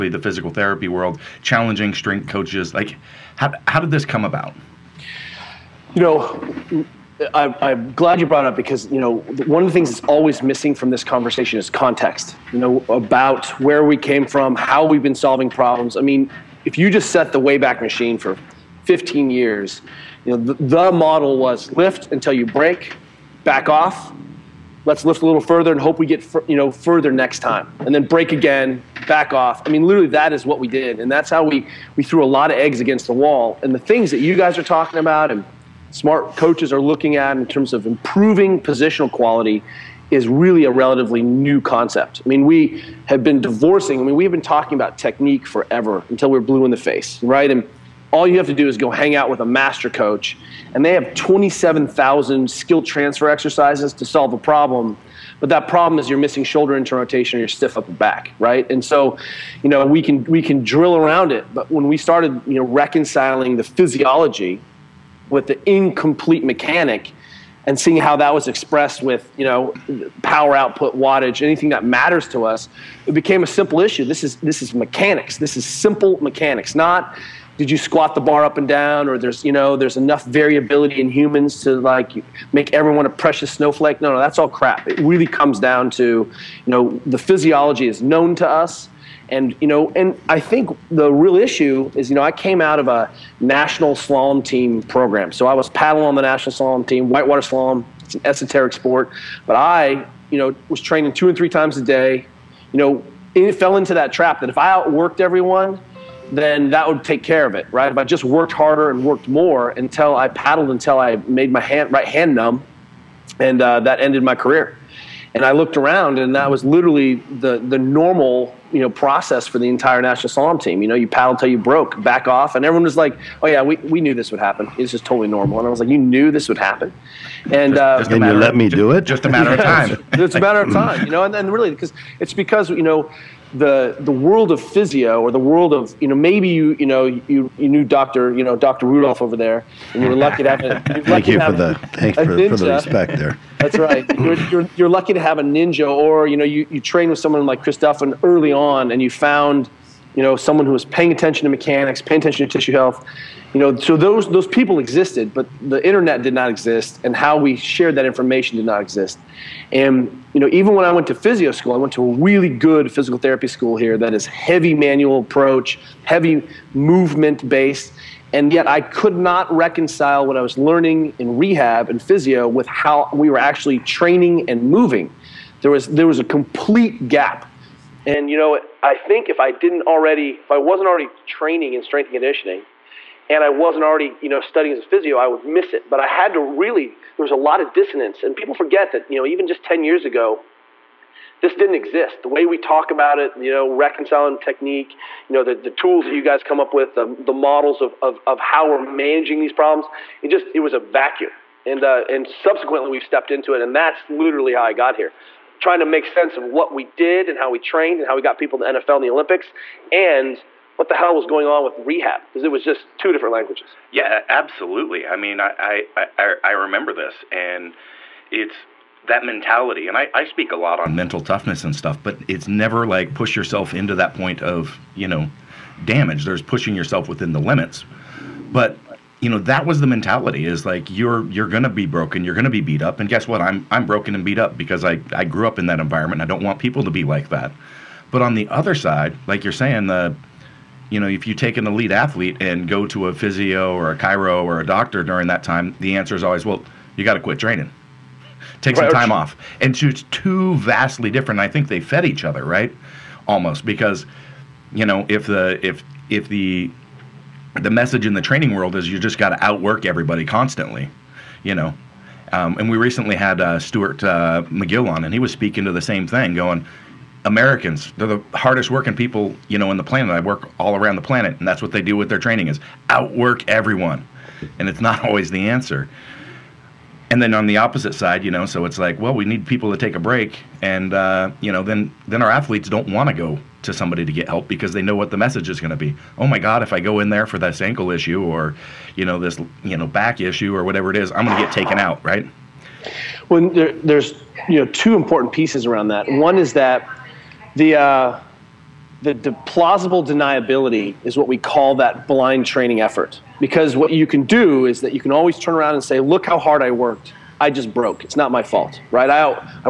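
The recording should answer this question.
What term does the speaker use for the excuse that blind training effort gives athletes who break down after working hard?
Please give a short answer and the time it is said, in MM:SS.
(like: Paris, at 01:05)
Plausible deniability, at 04:59.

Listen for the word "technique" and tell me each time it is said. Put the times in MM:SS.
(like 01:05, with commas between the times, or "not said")
00:44, 03:14.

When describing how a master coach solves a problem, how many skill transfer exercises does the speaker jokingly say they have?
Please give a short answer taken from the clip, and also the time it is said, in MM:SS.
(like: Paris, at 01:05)
27,000, at 00:51.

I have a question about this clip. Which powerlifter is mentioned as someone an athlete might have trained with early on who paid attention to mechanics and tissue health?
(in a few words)
Chris Duffin.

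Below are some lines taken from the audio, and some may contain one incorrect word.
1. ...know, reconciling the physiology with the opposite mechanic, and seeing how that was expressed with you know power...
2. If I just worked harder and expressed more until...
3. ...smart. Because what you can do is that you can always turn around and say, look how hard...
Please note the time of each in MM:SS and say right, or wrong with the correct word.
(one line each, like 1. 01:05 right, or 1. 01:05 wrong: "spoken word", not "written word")
1. 01:02 wrong: "incomplete", not "opposite"
2. 01:47 wrong: "worked", not "expressed"
3. 05:02 wrong: "effort", not "smart".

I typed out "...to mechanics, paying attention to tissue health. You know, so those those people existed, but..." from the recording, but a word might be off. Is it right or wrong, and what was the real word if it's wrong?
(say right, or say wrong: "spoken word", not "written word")
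right.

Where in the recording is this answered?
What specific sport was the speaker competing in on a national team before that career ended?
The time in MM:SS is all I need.
01:37.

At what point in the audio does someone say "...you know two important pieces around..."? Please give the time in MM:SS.
04:54.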